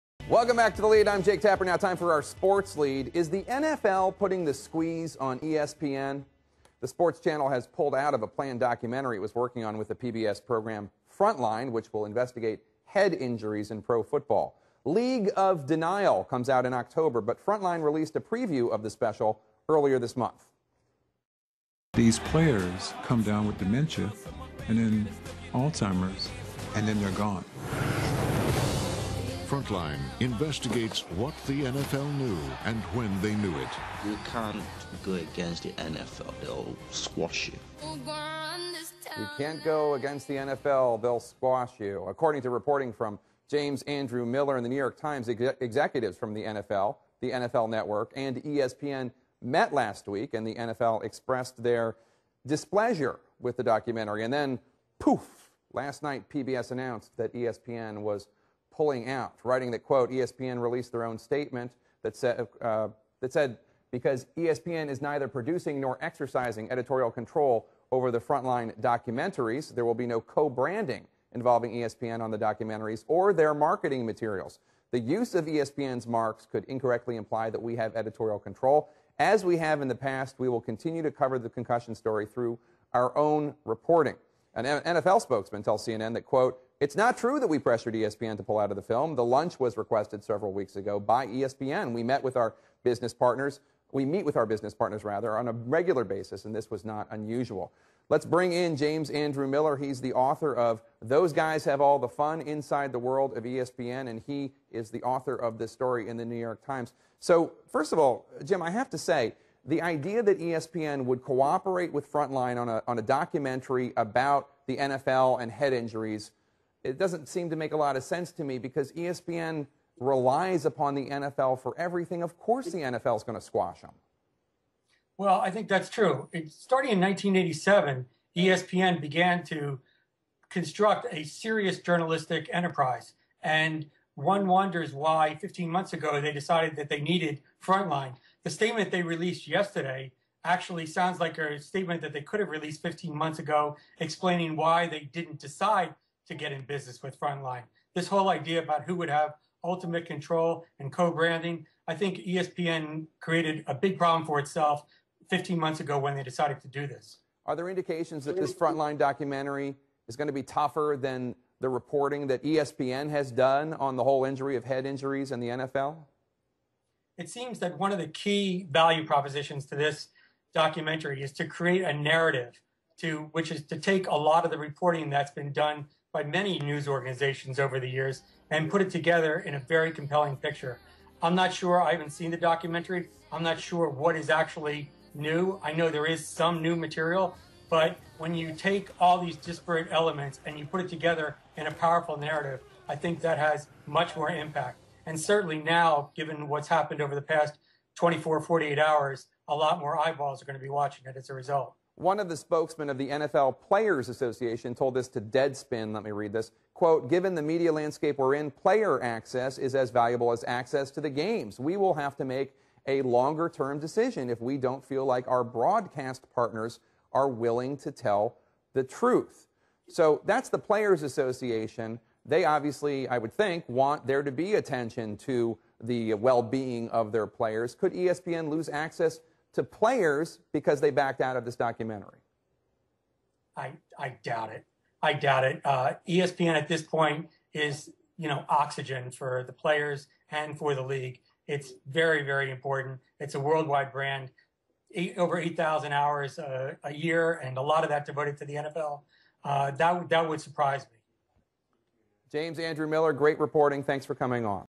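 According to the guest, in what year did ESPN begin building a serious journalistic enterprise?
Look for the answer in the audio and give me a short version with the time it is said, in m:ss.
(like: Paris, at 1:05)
1987, at 2:06.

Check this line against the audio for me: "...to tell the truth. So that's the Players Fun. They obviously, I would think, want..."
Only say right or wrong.
wrong.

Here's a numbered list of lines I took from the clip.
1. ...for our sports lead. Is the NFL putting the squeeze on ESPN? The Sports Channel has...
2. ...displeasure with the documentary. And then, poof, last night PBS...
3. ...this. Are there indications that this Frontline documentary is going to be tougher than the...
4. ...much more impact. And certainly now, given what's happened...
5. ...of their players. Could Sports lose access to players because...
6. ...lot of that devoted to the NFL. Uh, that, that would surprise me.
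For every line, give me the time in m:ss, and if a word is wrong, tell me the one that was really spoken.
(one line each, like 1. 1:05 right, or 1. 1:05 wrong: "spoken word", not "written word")
1. 0:01 right
2. 0:52 right
3. 2:36 right
4. 3:13 right
5. 3:46 wrong: "ESPN", not "Sports"
6. 4:07 right.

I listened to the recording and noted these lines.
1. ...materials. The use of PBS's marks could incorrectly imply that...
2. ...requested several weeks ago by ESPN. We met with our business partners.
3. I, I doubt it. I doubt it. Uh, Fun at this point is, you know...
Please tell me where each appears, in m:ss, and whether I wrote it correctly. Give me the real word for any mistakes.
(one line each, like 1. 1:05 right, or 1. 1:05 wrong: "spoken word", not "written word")
1. 1:14 wrong: "ESPN", not "PBS"
2. 1:29 right
3. 3:53 wrong: "ESPN", not "Fun".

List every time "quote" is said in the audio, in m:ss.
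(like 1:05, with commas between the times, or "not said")
0:59, 1:26, 3:26.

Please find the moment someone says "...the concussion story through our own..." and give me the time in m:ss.
1:21.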